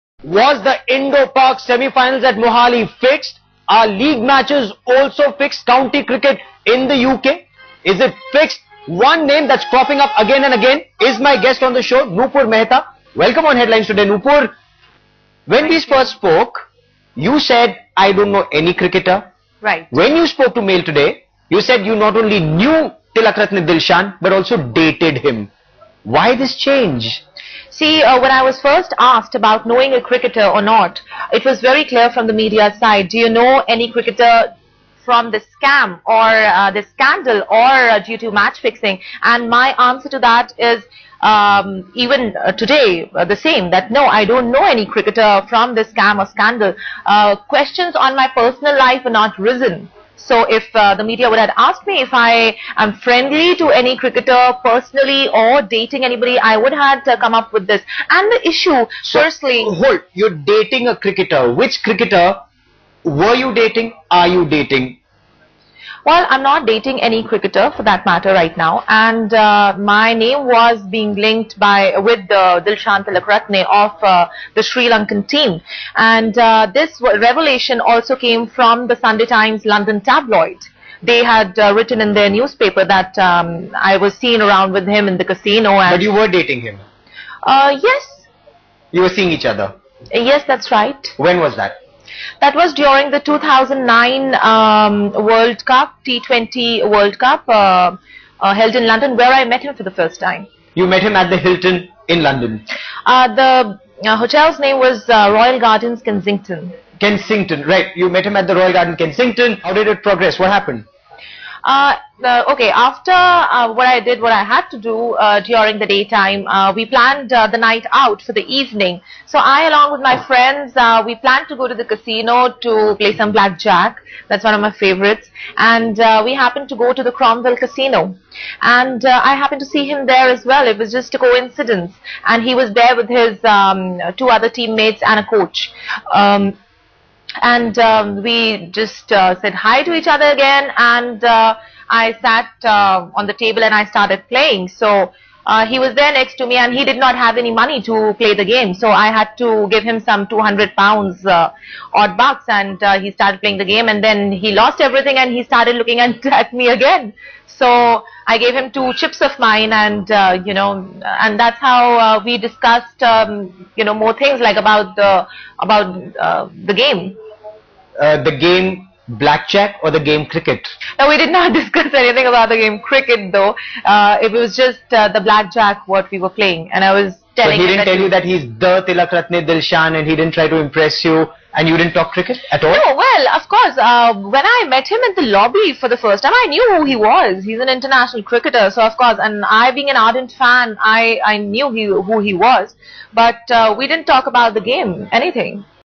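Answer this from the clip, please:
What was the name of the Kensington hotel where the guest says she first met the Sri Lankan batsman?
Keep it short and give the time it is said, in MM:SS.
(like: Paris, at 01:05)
Royal Gardens Kensington, at 01:45.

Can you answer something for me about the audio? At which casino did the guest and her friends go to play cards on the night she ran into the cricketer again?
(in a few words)
Cromwell Casino.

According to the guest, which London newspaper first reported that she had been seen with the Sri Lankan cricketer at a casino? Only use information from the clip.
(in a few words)
Sunday Times.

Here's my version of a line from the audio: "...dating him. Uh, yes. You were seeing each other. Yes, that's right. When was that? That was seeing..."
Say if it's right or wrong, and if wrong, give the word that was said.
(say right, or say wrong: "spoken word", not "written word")
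wrong: "during", not "seeing".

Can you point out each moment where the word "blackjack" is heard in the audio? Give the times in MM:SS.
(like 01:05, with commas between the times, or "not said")
02:03, 02:49, 02:55.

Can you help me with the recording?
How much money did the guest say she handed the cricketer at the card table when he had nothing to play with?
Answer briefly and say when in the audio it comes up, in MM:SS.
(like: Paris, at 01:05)
200 pounds, at 02:30.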